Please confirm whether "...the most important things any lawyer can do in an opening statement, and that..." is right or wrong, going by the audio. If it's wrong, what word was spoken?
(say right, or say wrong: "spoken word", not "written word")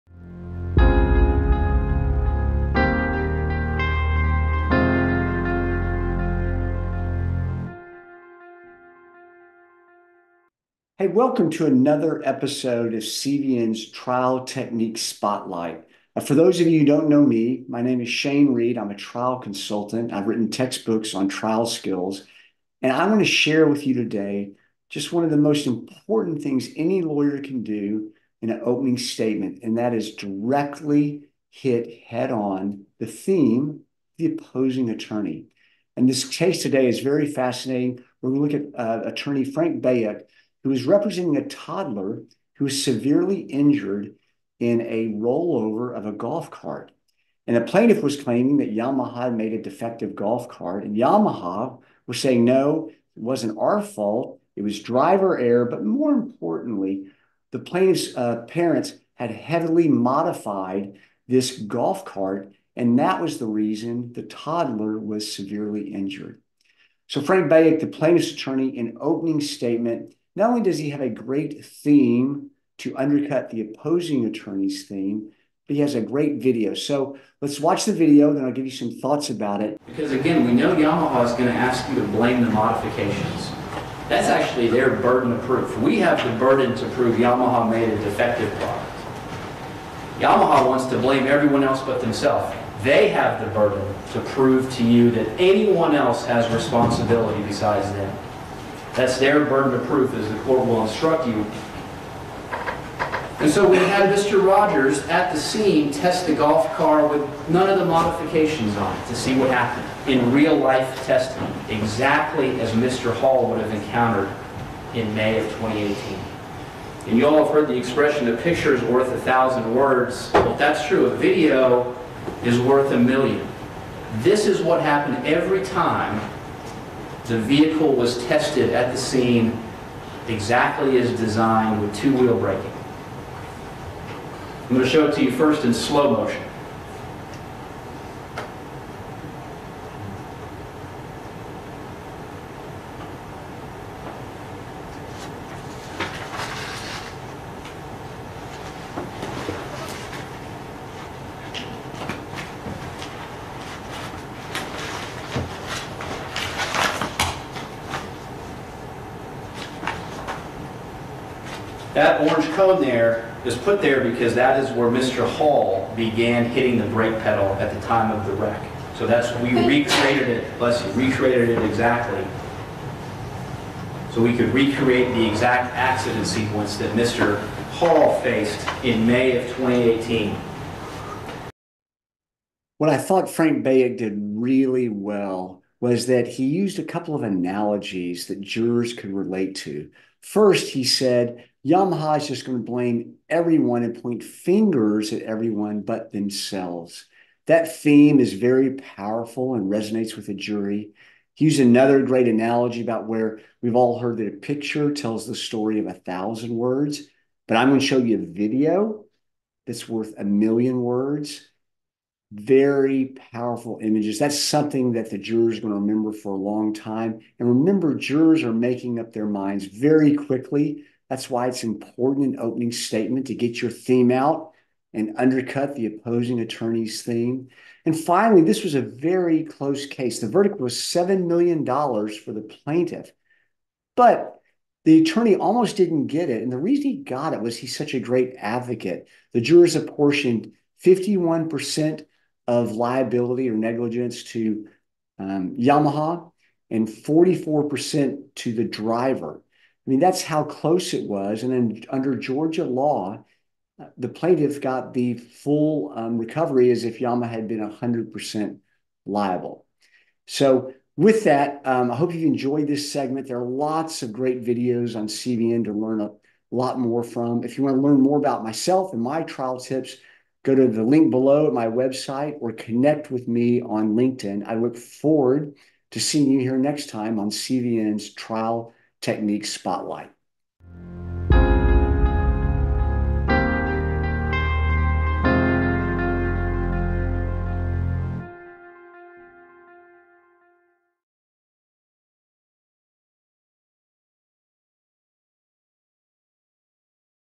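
right.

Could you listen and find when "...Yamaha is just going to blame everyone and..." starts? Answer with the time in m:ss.
3:11.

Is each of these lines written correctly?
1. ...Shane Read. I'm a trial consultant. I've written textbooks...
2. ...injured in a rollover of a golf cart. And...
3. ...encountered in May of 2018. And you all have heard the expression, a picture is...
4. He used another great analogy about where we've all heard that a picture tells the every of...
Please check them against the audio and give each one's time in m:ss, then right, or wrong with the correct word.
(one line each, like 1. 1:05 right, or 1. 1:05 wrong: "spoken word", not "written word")
1. 0:18 right
2. 0:43 right
3. 1:53 right
4. 3:21 wrong: "story", not "every".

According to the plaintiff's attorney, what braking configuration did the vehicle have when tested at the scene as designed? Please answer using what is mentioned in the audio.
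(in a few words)
Two-wheel braking.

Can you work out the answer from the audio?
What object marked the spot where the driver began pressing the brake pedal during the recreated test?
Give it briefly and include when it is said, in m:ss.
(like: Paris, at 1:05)
Orange cone, at 2:42.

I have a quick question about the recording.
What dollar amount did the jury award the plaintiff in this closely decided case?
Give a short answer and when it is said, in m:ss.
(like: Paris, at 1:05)
$7 million, at 3:50.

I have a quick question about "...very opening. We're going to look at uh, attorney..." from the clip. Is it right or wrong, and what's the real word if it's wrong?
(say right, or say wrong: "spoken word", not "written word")
wrong: "fascinating", not "opening".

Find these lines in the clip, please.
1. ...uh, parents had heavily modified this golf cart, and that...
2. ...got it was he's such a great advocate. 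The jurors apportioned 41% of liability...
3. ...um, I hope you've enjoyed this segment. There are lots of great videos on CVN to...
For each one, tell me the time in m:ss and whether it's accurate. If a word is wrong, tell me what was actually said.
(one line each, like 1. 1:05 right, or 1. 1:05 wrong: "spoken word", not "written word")
1. 0:58 right
2. 3:56 wrong: "51", not "41"
3. 4:21 right.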